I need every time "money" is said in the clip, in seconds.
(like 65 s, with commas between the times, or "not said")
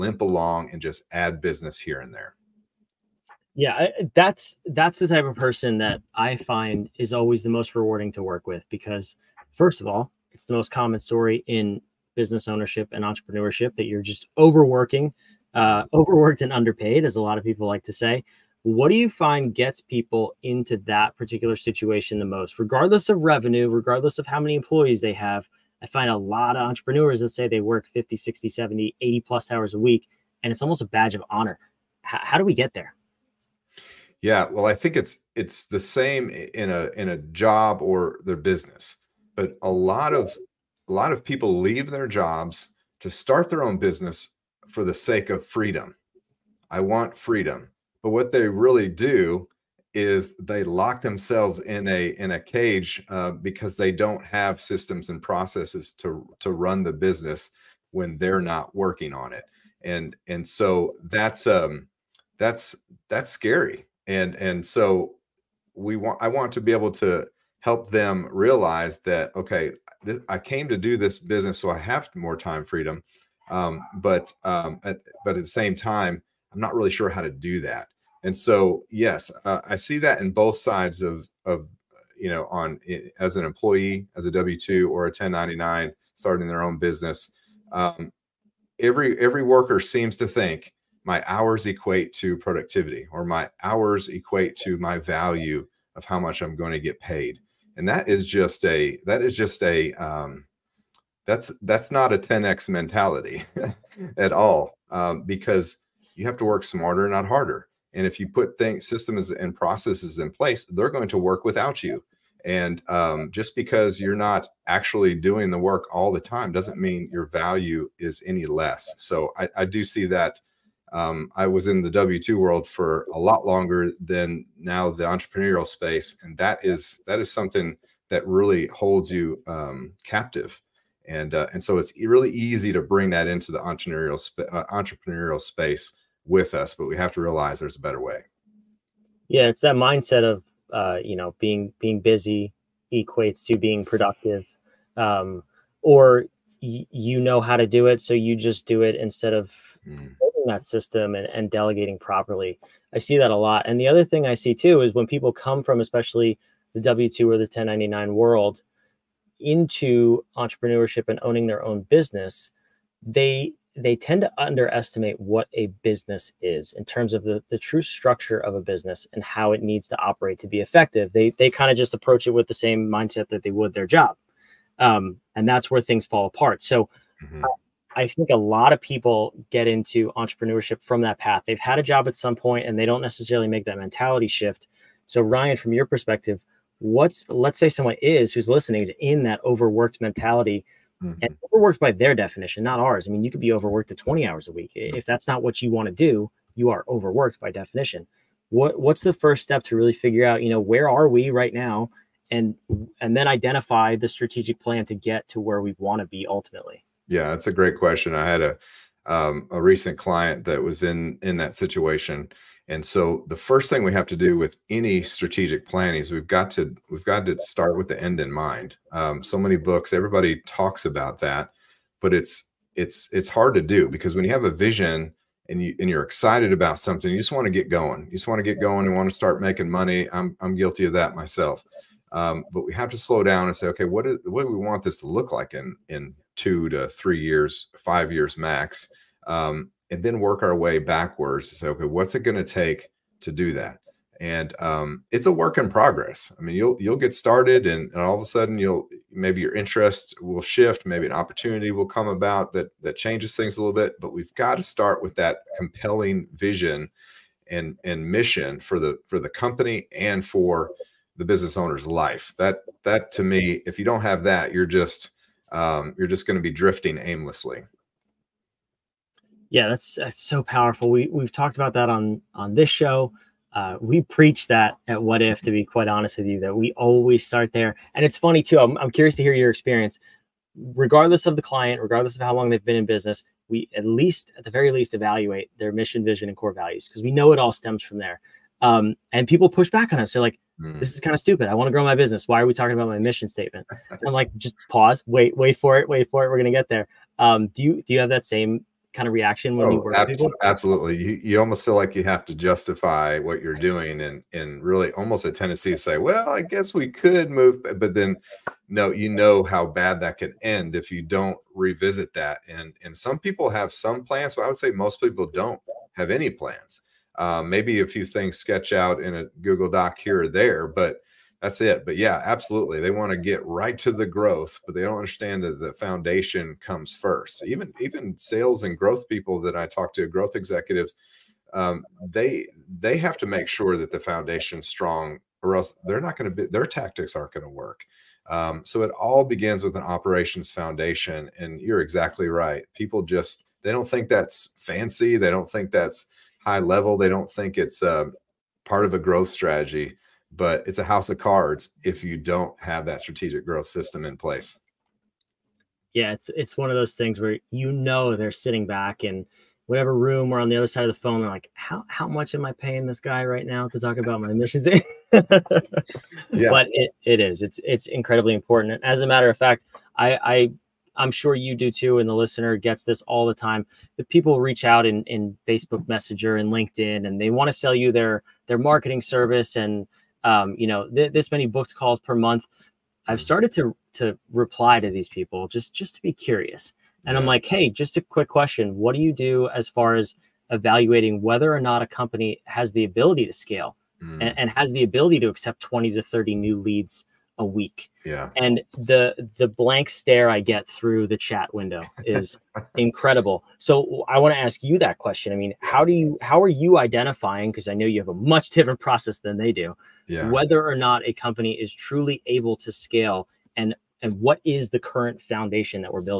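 229 s.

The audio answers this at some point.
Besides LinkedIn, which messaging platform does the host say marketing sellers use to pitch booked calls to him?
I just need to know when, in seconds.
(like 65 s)
375 s.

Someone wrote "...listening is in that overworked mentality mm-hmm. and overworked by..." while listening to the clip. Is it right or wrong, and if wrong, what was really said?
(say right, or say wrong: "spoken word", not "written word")
right.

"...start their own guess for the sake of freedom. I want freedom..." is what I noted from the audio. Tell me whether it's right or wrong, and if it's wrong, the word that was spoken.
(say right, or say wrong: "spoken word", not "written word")
wrong: "business", not "guess".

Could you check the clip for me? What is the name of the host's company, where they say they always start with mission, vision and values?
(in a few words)
Whadif.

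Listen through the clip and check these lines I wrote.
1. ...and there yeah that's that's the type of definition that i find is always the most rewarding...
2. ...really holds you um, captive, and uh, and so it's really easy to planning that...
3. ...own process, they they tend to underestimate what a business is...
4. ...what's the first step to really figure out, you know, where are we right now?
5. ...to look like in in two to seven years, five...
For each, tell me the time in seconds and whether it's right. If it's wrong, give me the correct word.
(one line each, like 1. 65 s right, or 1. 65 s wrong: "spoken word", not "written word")
1. 1 s wrong: "person", not "definition"
2. 128 s wrong: "bring", not "planning"
3. 161 s wrong: "business", not "process"
4. 198 s right
5. 235 s wrong: "three", not "seven".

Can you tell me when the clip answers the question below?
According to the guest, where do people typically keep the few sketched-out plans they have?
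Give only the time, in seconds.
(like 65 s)
319 s.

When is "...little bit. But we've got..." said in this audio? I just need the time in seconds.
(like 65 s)
253 s.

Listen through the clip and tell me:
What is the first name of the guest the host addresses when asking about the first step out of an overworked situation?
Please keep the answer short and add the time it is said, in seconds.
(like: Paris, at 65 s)
Ryan, at 185 s.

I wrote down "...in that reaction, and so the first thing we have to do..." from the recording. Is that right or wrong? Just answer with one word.
wrong.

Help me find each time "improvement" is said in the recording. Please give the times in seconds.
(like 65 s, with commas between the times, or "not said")
not said.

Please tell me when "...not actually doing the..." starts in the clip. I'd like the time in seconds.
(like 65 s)
114 s.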